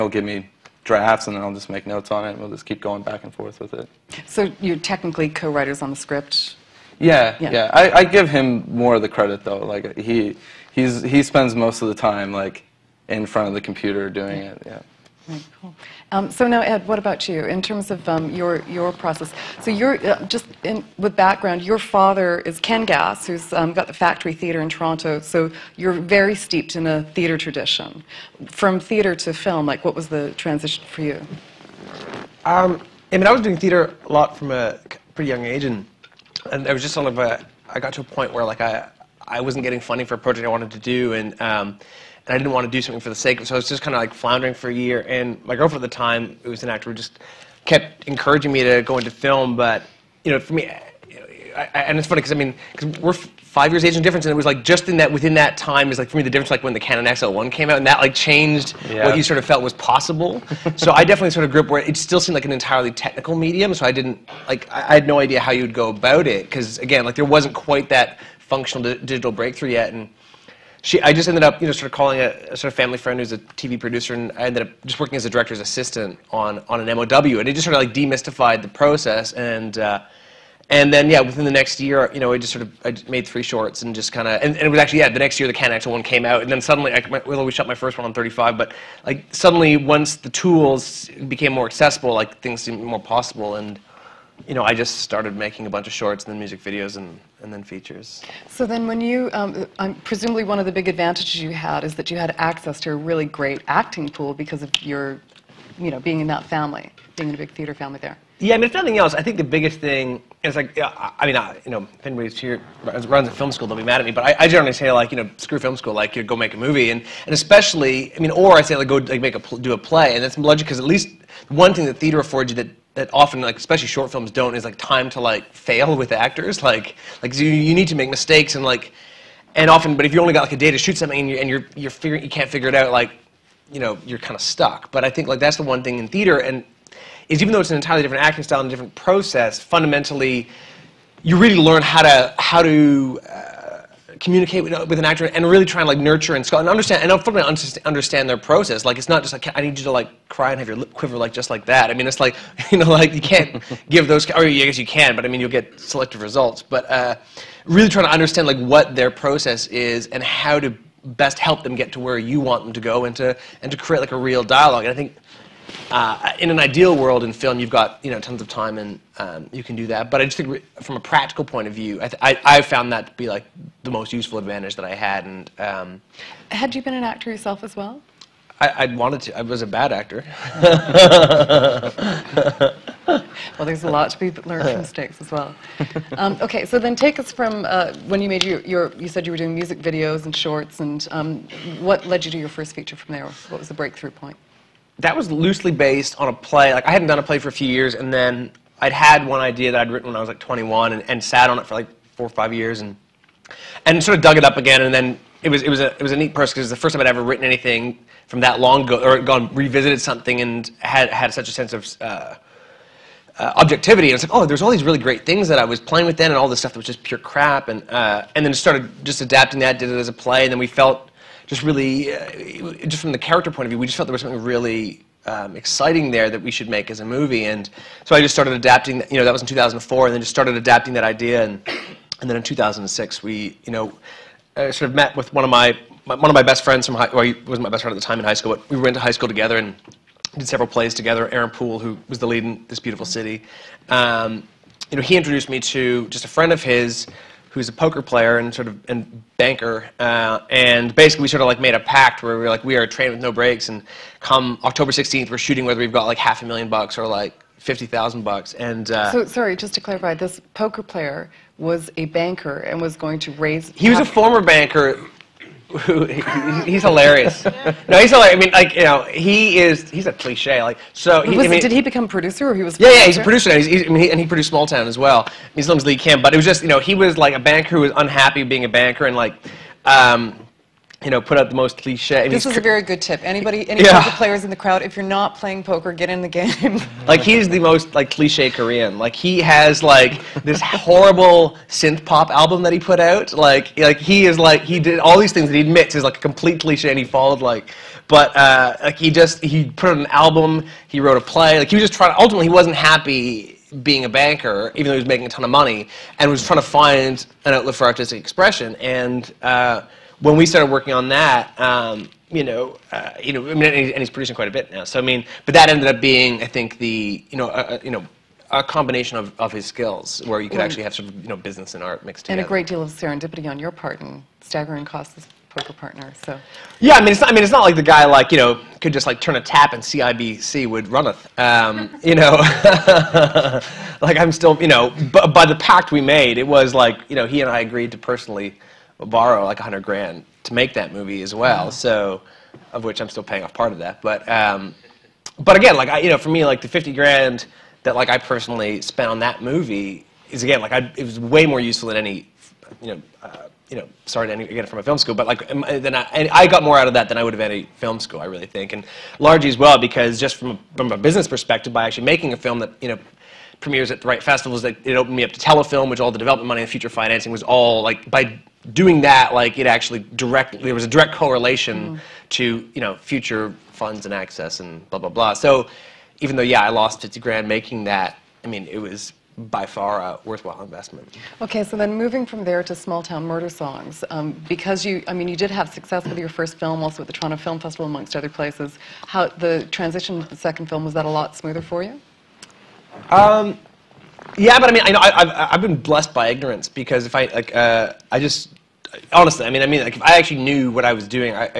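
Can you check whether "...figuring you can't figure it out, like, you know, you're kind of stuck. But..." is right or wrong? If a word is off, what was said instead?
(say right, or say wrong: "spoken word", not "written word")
right.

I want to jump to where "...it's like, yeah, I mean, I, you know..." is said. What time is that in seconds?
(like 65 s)
110 s.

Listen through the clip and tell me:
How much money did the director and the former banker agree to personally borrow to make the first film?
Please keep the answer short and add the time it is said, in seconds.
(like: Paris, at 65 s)
100 grand, at 339 s.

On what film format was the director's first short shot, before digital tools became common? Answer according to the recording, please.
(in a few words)
35.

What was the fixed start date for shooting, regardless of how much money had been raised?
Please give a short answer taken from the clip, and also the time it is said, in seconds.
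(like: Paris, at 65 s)
October 16th, at 254 s.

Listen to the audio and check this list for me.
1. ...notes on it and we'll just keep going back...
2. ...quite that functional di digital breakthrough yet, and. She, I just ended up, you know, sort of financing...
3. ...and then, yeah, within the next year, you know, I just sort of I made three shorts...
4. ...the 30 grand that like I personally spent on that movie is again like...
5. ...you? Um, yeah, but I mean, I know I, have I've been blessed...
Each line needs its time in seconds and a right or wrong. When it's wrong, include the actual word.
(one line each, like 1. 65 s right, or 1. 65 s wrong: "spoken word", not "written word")
1. 1 s right
2. 67 s wrong: "calling", not "financing"
3. 80 s right
4. 346 s wrong: "50", not "30"
5. 391 s right.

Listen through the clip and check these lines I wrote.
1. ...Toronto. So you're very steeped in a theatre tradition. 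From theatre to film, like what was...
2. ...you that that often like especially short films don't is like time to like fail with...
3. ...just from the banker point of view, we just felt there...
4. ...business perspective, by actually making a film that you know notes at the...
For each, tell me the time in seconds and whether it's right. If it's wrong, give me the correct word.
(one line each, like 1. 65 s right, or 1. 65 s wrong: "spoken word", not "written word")
1. 24 s right
2. 122 s right
3. 222 s wrong: "character", not "banker"
4. 360 s wrong: "premieres", not "notes".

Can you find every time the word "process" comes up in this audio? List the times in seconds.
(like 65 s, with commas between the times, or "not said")
18 s, 78 s, 138 s, 148 s, 159 s.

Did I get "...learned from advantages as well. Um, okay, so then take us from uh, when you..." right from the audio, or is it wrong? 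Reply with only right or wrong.
wrong.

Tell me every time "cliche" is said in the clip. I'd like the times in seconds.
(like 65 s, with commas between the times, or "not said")
270 s, 281 s, 288 s, 296 s.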